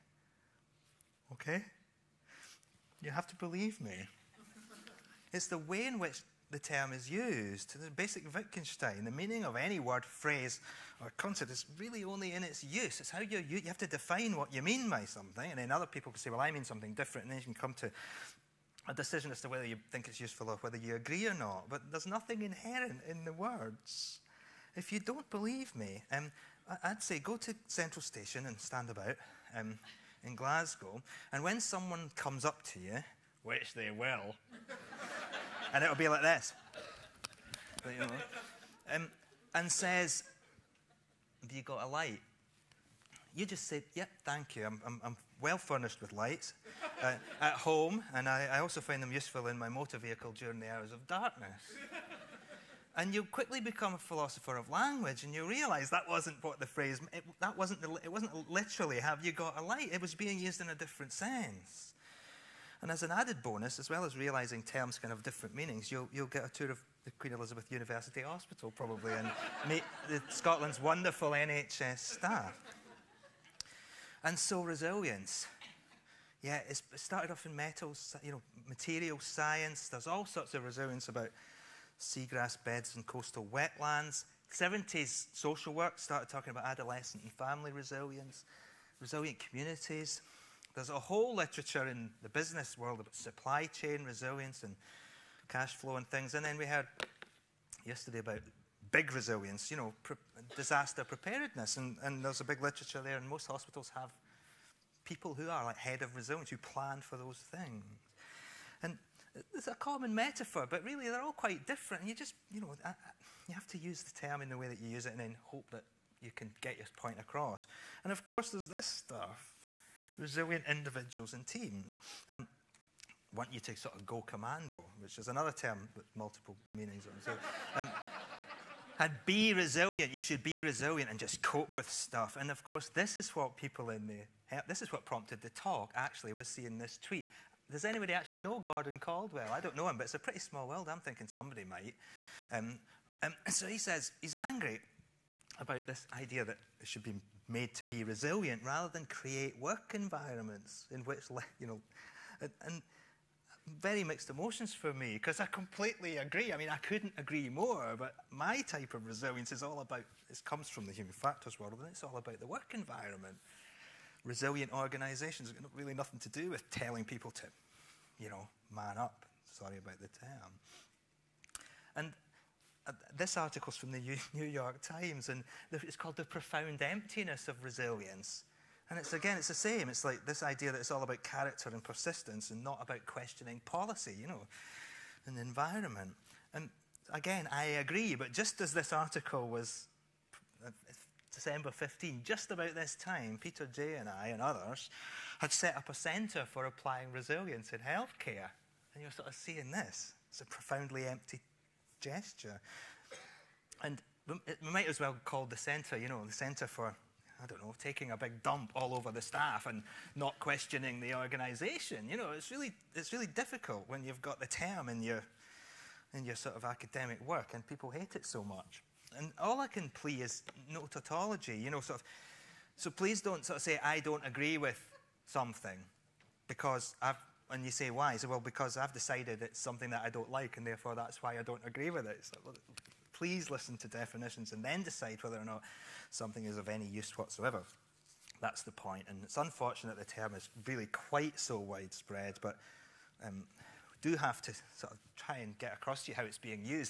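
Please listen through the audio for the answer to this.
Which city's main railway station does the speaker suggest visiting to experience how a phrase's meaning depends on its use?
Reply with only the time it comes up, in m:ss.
0:30.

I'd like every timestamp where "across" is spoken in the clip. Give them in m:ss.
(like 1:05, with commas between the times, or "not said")
1:57, 4:05.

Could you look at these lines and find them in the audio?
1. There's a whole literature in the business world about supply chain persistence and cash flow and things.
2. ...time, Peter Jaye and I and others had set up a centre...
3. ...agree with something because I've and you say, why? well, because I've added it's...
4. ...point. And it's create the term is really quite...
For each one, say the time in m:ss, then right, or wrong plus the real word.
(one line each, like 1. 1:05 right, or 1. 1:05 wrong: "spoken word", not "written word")
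1. 1:30 wrong: "resilience", not "persistence"
2. 3:12 right
3. 3:44 wrong: "decided", not "added"
4. 3:58 wrong: "unfortunate", not "create".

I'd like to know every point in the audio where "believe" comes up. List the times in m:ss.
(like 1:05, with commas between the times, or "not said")
0:03, 0:25.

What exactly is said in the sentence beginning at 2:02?
Um, want you to sort of go commando, which is another term with multiple meanings.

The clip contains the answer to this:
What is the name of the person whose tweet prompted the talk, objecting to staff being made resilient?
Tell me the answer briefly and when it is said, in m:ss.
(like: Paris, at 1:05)
Gordon Caldwell, at 2:18.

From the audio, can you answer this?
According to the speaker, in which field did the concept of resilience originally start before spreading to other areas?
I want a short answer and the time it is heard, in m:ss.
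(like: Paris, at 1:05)
Material science, at 1:18.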